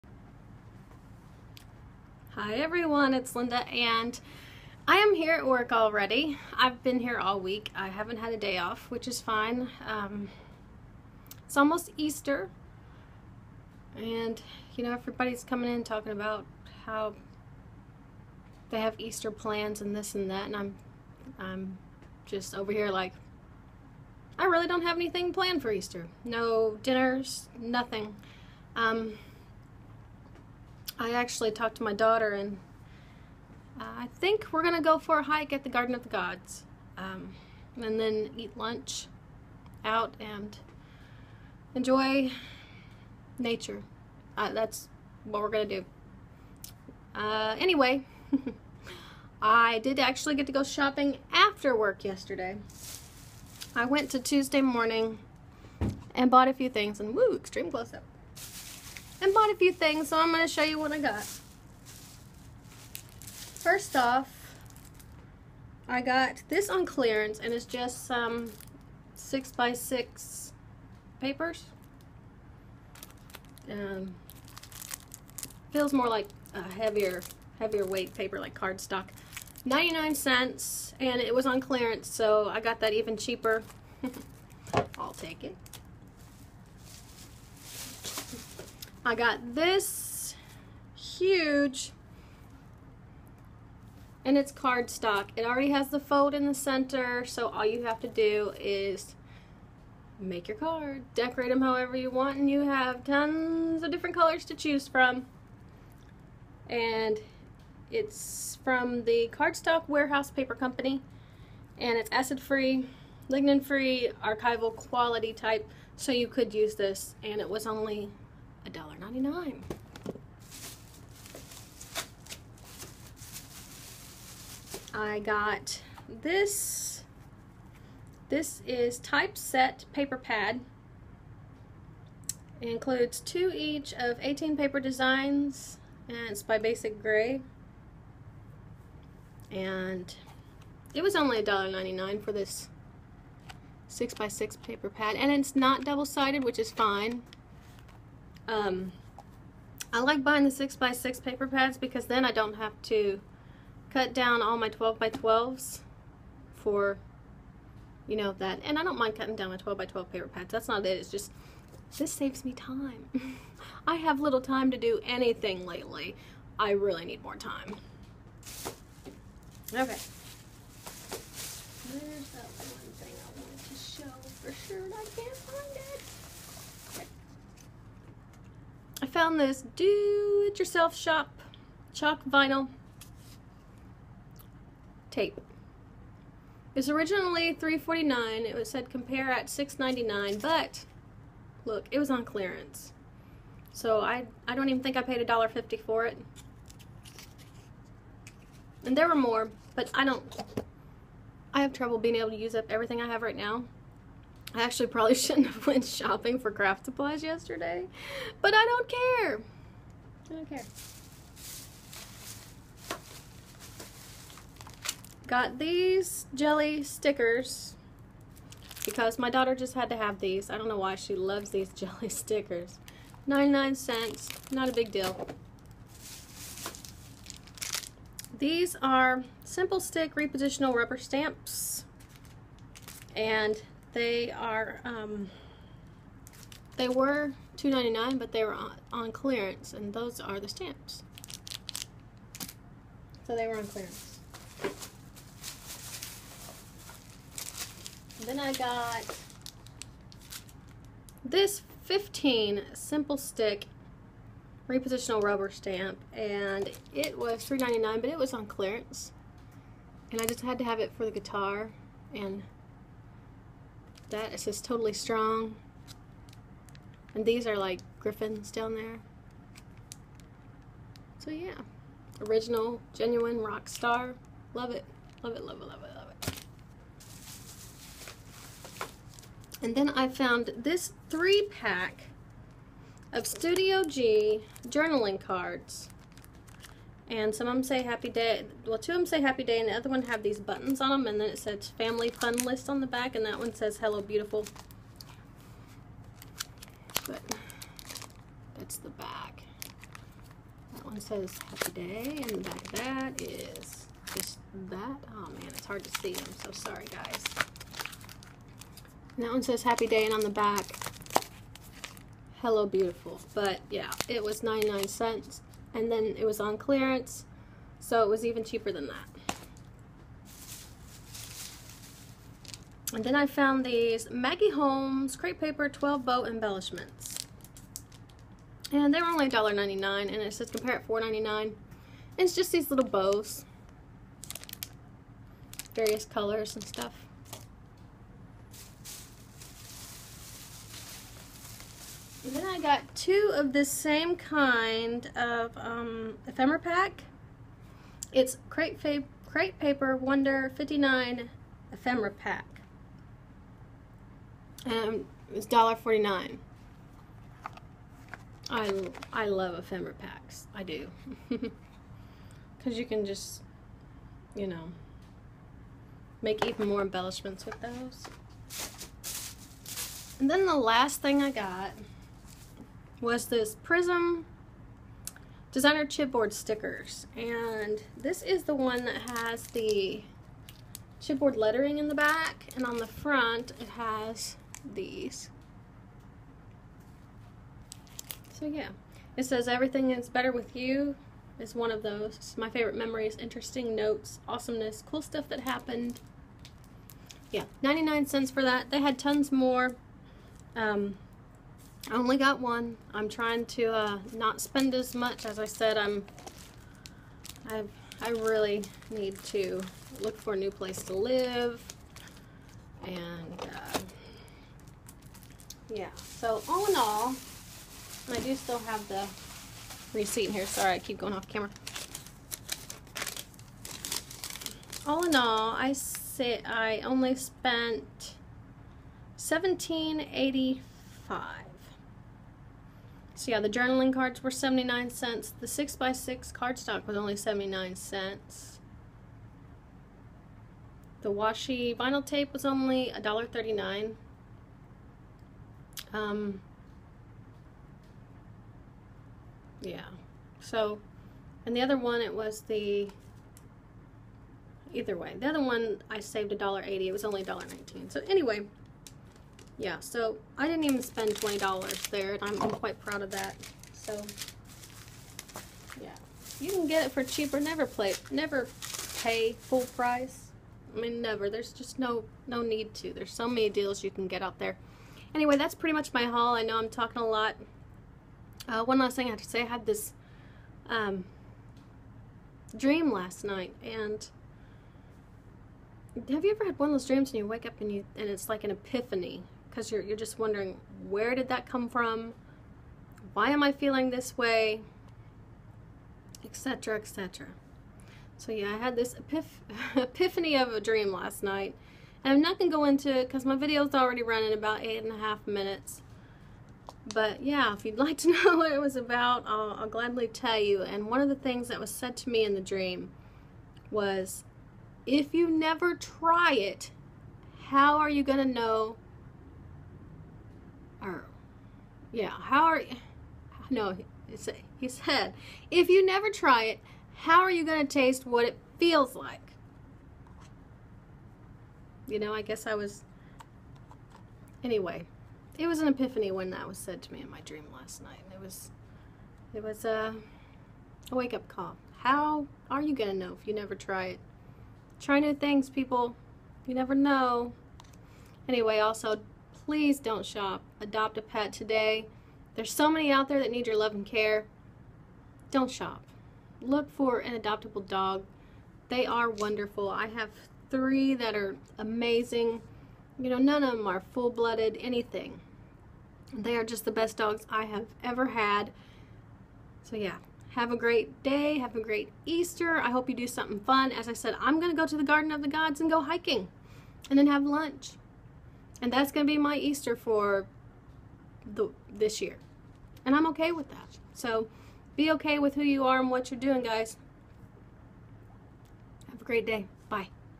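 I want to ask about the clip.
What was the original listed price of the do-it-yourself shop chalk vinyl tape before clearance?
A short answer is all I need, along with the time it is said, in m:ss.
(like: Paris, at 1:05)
$3.49, at 3:07.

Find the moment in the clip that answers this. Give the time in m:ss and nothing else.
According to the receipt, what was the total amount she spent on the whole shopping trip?
7:09.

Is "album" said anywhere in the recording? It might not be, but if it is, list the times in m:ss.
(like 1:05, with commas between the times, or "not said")
not said.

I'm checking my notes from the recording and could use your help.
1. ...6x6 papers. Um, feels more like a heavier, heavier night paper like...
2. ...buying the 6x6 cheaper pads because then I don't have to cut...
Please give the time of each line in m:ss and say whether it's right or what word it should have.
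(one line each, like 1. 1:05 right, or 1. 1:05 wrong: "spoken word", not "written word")
1. 1:09 wrong: "weight", not "night"
2. 2:30 wrong: "paper", not "cheaper".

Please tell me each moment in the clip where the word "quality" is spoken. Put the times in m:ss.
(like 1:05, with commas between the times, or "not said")
1:54.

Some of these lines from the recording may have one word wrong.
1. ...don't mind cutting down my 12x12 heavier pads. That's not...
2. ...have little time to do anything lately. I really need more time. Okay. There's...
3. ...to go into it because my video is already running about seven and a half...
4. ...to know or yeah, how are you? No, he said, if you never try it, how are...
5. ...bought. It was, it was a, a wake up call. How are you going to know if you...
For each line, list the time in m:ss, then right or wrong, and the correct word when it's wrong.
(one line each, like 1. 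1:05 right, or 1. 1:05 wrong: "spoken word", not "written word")
1. 2:38 wrong: "paper", not "heavier"
2. 2:43 right
3. 8:22 wrong: "eight", not "seven"
4. 8:38 right
5. 8:57 wrong: "night", not "bought".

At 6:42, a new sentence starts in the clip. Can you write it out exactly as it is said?
I'm trying to uh, not spend as much.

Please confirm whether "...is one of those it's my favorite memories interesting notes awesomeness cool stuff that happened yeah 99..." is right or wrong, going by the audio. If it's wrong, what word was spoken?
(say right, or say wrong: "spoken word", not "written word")
right.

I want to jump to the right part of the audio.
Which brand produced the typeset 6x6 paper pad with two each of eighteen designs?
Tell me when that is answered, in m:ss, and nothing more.
2:16.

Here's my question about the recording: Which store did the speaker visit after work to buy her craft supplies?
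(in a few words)
Tuesday Morning.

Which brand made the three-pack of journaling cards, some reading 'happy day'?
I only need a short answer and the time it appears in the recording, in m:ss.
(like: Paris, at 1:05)
Studio G, at 4:43.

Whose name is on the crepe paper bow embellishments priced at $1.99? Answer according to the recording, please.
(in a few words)
Maggie Holmes.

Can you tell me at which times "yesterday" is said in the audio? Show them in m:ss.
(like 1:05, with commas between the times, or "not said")
0:52, 3:27.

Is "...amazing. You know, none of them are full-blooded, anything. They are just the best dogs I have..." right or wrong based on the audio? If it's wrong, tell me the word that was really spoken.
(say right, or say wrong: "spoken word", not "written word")
right.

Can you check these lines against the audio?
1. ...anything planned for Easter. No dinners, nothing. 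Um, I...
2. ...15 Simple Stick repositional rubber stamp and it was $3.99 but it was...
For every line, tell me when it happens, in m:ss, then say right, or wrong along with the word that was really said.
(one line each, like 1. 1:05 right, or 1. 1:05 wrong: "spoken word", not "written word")
1. 0:24 right
2. 4:11 right.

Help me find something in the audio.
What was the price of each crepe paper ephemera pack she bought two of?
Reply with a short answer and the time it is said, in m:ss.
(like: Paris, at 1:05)
$1.49, at 5:55.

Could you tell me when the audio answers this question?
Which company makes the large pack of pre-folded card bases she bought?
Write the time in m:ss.
1:49.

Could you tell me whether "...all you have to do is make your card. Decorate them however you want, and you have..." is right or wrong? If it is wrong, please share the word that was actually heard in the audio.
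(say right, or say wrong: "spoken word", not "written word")
right.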